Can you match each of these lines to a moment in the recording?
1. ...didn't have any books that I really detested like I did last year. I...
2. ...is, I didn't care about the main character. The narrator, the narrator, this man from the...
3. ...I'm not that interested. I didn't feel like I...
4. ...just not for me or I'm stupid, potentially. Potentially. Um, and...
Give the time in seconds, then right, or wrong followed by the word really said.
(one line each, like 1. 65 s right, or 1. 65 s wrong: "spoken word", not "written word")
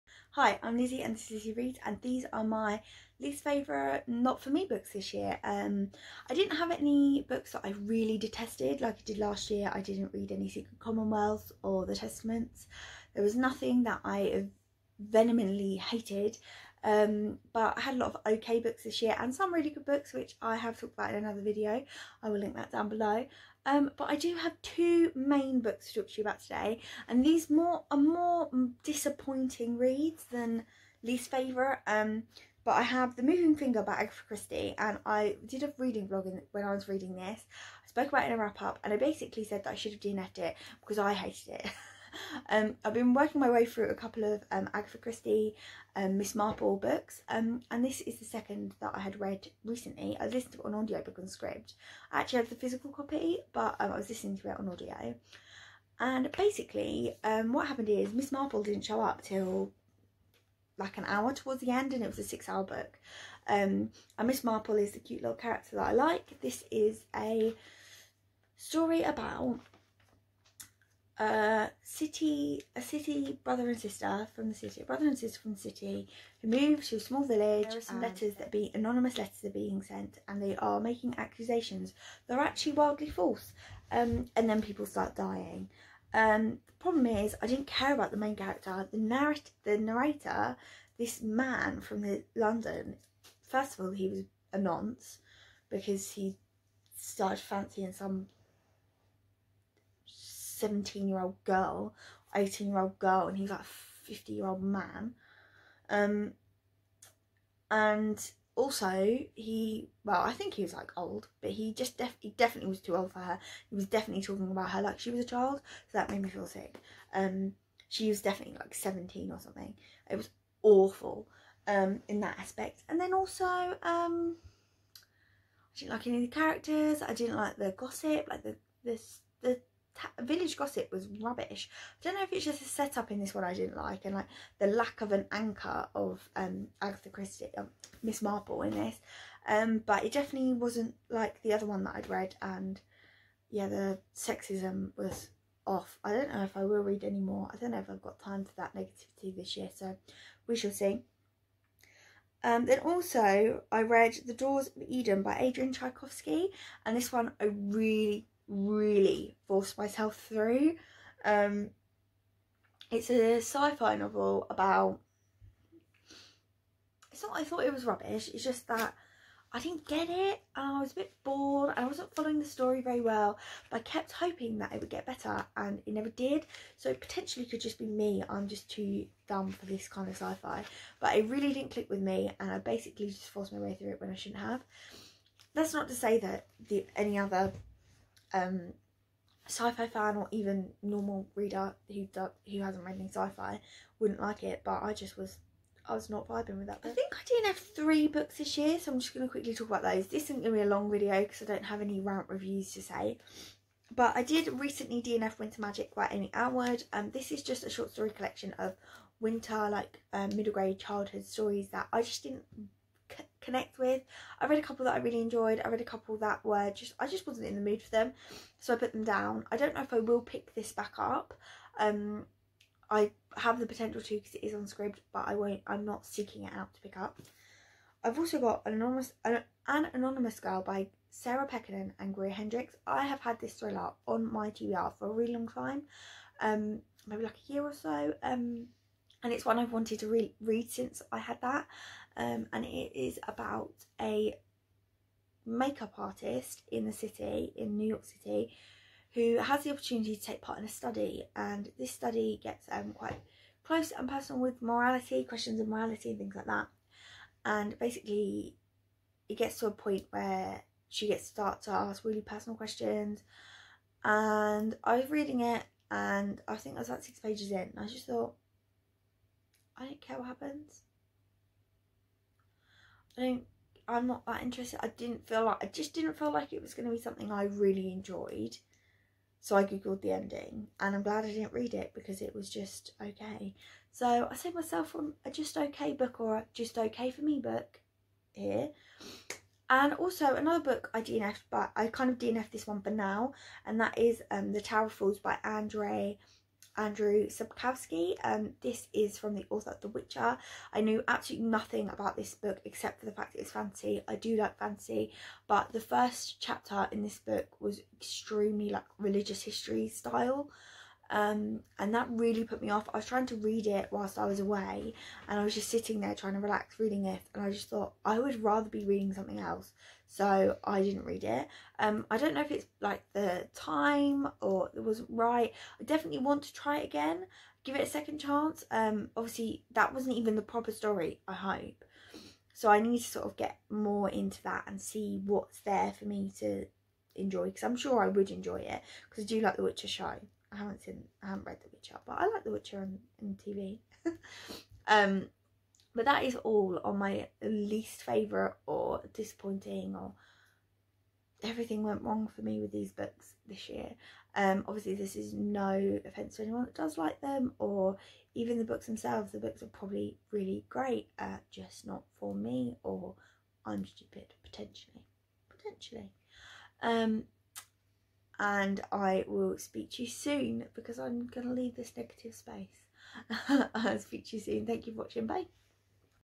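1. 6 s right
2. 87 s right
3. 273 s right
4. 361 s right.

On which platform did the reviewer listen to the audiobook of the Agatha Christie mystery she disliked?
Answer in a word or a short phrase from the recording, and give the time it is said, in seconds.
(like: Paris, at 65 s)
Scribd, at 51 s.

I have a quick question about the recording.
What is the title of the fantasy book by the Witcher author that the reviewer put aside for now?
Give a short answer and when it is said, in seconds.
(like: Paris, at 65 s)
The Tower Falls, at 294 s.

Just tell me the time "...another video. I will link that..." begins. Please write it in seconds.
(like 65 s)
21 s.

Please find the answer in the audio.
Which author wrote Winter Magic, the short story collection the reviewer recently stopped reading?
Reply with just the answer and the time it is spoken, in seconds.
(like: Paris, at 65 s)
Amy Alward, at 206 s.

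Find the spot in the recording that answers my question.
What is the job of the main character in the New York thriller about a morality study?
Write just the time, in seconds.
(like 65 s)
245 s.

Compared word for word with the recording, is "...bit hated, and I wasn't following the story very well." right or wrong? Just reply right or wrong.
wrong.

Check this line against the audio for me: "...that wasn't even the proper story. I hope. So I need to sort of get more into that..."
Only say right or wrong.
right.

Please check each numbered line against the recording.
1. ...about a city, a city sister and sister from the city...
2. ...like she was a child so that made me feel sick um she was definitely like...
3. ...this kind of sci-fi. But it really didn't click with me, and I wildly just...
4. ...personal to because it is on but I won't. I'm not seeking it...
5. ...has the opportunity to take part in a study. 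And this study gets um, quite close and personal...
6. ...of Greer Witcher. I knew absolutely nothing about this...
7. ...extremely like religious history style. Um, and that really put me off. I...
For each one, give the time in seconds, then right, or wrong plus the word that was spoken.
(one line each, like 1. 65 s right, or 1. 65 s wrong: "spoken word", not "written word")
1. 69 s wrong: "brother", not "sister"
2. 114 s right
3. 179 s wrong: "basically", not "wildly"
4. 223 s wrong: "potential", not "personal"
5. 249 s right
6. 299 s wrong: "The", not "Greer"
7. 307 s right.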